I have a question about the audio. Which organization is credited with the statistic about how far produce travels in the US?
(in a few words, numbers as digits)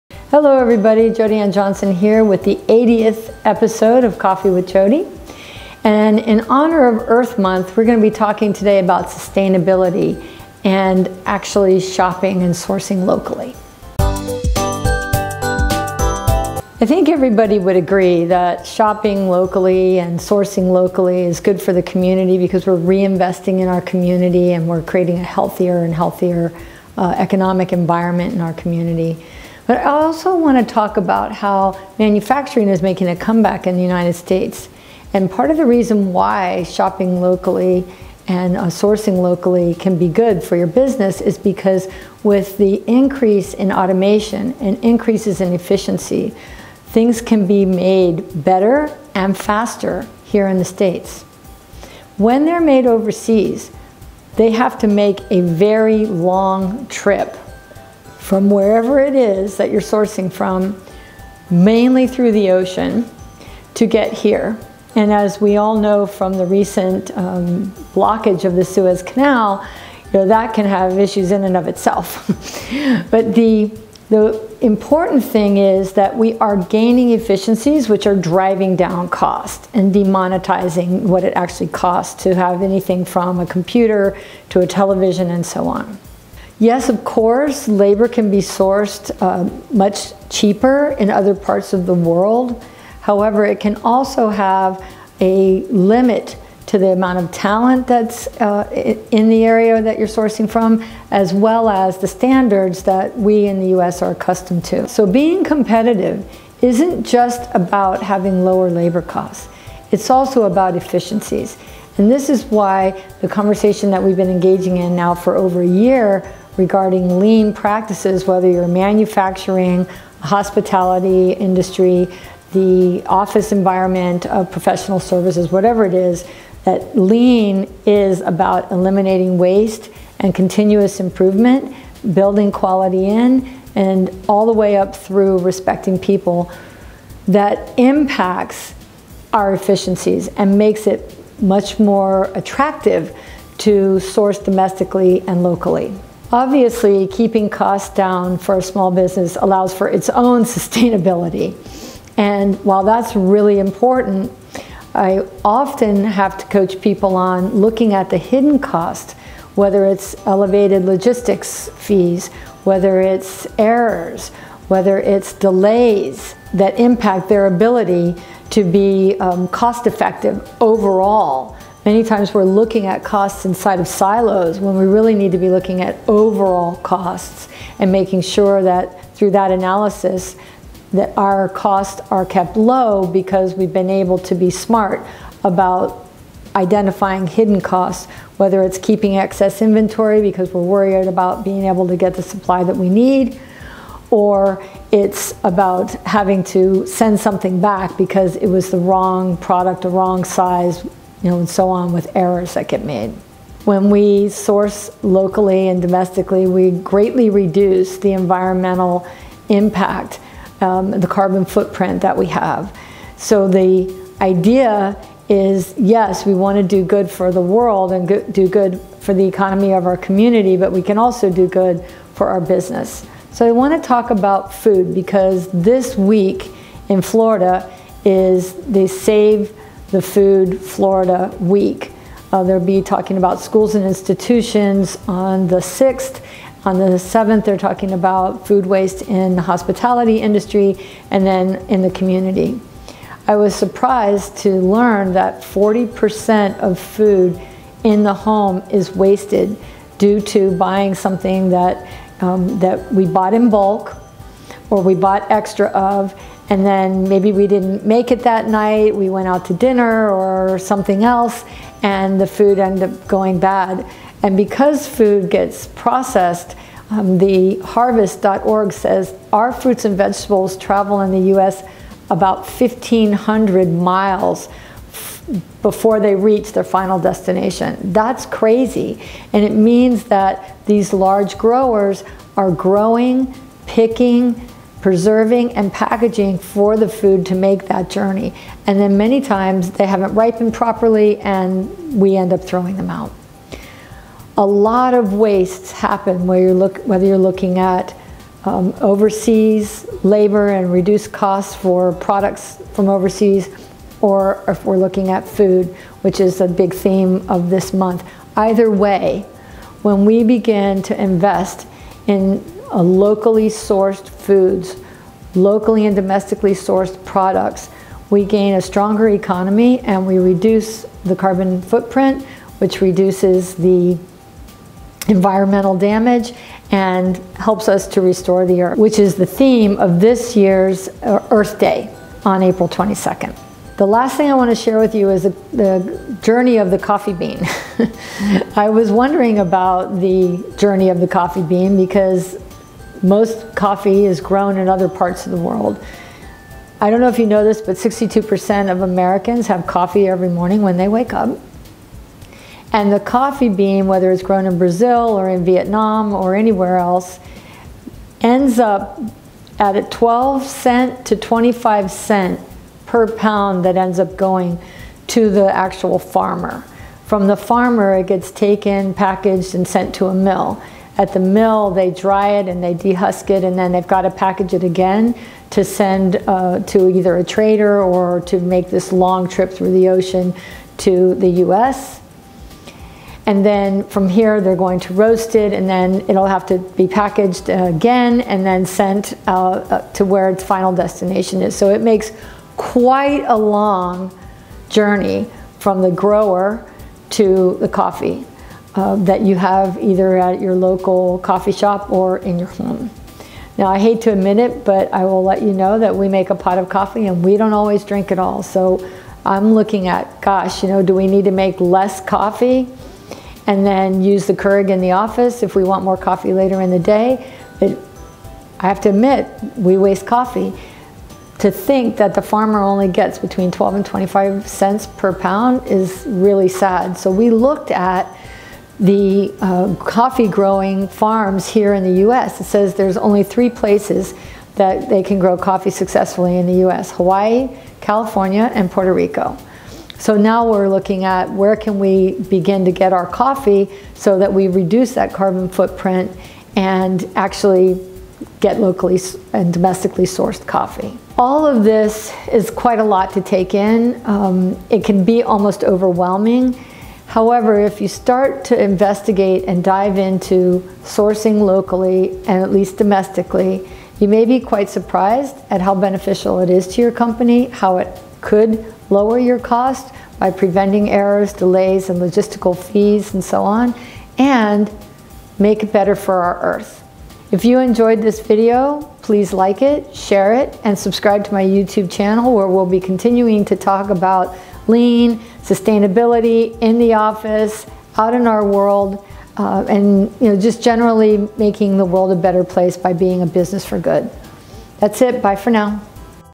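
harvest.org.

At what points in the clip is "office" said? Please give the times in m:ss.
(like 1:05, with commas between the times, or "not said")
2:03, 6:54, 8:06.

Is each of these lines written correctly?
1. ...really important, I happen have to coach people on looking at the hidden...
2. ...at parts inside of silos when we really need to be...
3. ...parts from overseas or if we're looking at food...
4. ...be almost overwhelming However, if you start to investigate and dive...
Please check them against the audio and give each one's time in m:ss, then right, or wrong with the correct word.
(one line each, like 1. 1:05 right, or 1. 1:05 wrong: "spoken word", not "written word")
1. 2:33 wrong: "often", not "happen"
2. 2:52 wrong: "costs", not "parts"
3. 5:01 wrong: "products", not "parts"
4. 7:35 right.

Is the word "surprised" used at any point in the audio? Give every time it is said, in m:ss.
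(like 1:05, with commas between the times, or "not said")
4:03, 7:44.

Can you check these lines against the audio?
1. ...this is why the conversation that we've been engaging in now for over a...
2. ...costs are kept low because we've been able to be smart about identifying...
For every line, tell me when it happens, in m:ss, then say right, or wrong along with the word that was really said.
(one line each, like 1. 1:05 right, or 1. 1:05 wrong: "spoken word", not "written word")
1. 1:52 right
2. 3:01 right.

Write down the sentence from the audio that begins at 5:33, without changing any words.
The last thing I want to share with you is the, the journey of the coffee bean.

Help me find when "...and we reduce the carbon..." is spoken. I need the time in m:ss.
5:19.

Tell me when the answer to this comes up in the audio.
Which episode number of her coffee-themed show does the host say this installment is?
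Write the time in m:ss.
0:02.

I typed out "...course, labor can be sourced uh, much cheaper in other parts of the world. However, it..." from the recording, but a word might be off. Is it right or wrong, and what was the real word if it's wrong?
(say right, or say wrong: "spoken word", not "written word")
right.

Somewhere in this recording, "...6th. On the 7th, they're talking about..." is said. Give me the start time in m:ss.
3:55.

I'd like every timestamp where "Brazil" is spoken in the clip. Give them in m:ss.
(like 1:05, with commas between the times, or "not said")
5:54.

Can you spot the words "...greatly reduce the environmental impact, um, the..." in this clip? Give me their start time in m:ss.
3:26.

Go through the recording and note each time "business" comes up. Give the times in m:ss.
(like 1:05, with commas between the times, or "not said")
0:40, 2:28, 3:42, 8:13.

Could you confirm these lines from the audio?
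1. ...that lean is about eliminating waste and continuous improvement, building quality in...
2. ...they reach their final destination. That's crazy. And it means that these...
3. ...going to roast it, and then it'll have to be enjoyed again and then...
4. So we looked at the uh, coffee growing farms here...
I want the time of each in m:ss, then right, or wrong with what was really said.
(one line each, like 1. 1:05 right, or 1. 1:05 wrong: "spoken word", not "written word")
1. 2:06 right
2. 4:36 right
3. 6:24 wrong: "packaged", not "enjoyed"
4. 7:06 right.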